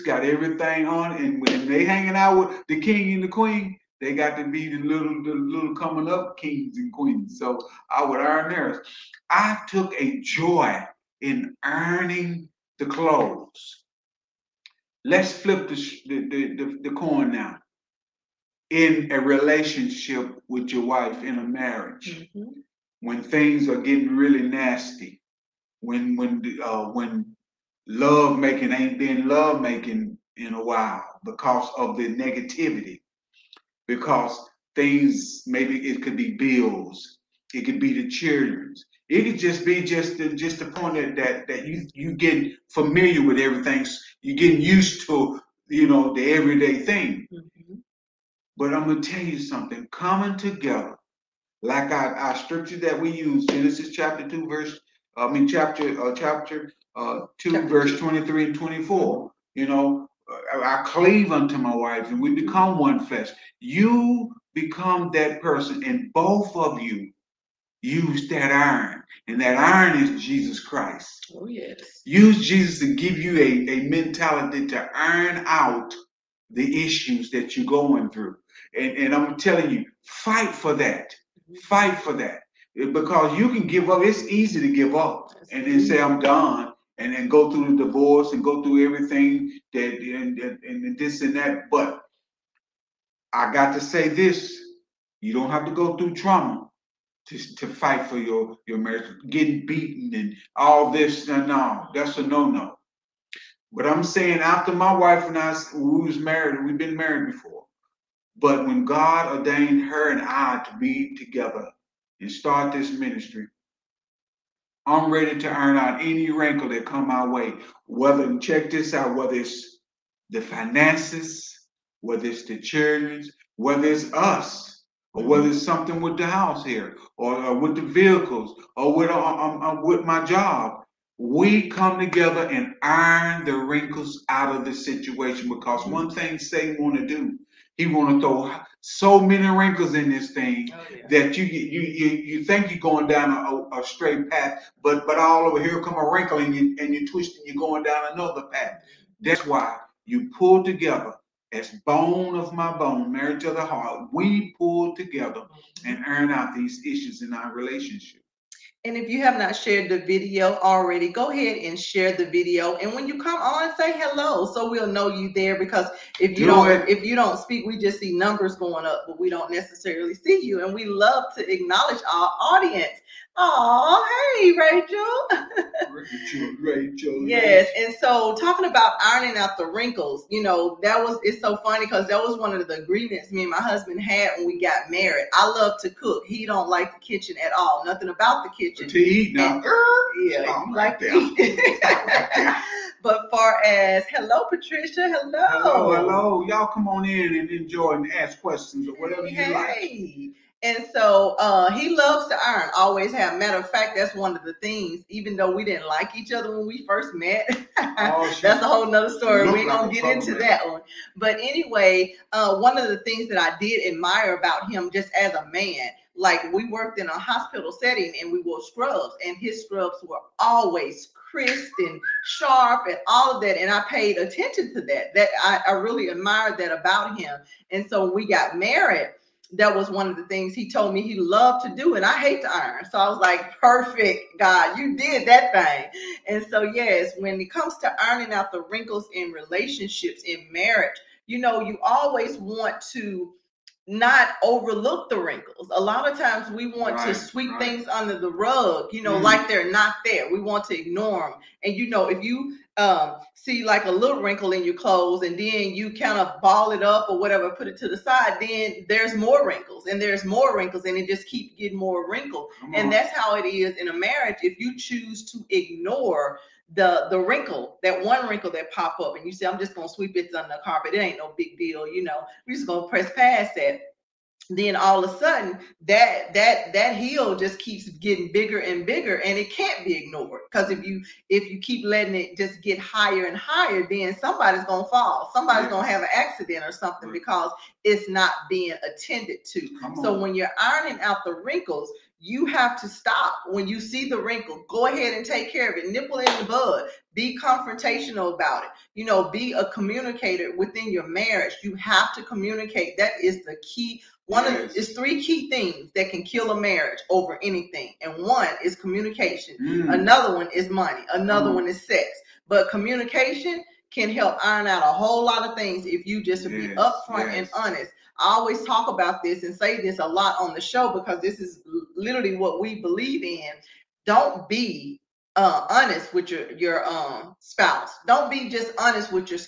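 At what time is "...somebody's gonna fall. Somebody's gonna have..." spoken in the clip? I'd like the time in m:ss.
4:44.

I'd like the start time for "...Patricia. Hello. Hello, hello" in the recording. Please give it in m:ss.
3:14.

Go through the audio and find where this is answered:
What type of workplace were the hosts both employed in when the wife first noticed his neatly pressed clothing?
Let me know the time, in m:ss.
3:37.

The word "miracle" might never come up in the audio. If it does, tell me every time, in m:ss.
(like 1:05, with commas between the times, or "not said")
not said.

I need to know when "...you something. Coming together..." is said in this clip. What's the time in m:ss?
0:49.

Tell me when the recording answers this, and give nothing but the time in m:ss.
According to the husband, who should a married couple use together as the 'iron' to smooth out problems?
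1:10.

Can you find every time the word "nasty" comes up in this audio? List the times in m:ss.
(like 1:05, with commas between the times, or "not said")
0:24.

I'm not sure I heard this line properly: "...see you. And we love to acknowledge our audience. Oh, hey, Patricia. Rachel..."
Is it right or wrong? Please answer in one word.
wrong.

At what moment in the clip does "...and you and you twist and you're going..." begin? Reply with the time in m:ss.
2:26.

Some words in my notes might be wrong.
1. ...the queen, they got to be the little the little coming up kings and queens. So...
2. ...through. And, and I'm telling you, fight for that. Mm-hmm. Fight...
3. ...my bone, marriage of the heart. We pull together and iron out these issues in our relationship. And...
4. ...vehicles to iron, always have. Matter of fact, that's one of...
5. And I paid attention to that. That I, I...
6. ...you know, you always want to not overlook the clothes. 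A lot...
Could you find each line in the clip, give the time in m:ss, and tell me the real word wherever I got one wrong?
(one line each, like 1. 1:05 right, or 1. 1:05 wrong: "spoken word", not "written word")
1. 0:03 right
2. 1:18 right
3. 2:32 right
4. 3:21 wrong: "loves", not "vehicles"
5. 3:43 right
6. 4:01 wrong: "wrinkles", not "clothes".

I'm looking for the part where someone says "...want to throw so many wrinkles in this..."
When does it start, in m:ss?
2:17.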